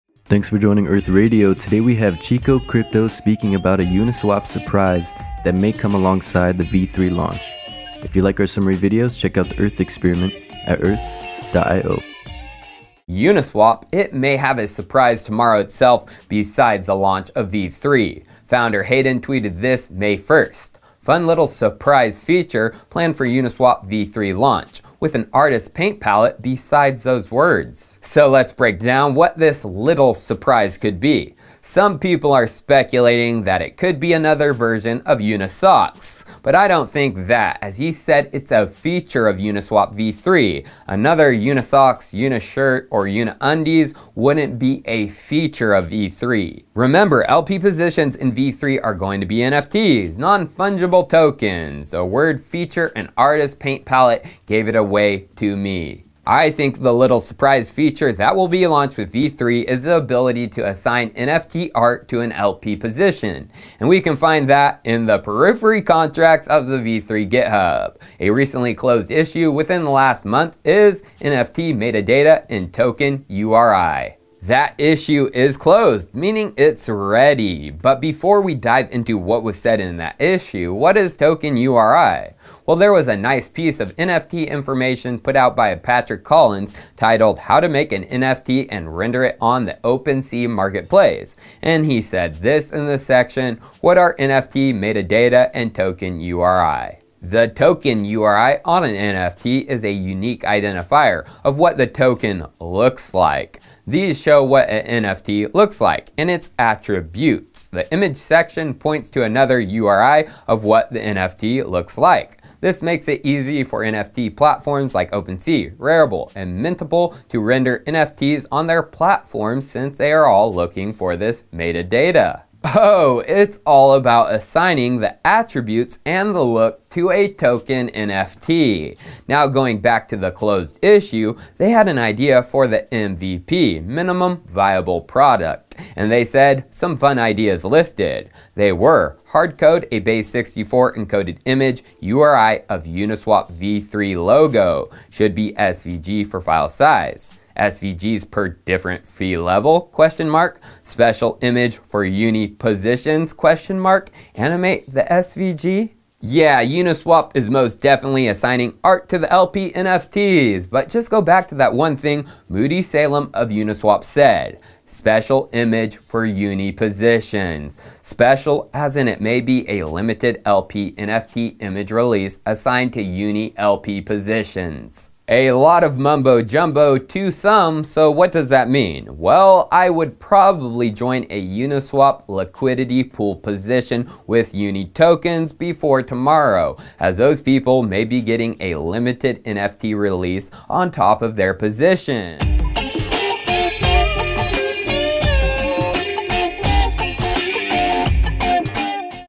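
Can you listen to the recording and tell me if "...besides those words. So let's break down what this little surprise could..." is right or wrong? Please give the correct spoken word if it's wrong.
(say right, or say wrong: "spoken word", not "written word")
right.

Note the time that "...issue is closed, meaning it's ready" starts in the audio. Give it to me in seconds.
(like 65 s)
74 s.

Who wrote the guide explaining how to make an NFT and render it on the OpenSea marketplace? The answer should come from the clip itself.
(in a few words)
Patrick Collins.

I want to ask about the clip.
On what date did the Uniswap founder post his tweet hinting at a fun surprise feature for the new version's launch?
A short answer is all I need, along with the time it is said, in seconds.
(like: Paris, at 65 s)
May 1st, at 19 s.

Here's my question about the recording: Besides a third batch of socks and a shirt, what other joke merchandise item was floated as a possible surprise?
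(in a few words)
Uniundies.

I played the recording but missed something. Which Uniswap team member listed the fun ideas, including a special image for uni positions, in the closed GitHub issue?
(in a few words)
Moody Salem.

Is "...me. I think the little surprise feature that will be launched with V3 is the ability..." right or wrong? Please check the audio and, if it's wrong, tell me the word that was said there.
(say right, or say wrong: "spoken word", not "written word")
right.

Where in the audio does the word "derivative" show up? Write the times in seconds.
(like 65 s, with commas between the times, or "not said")
not said.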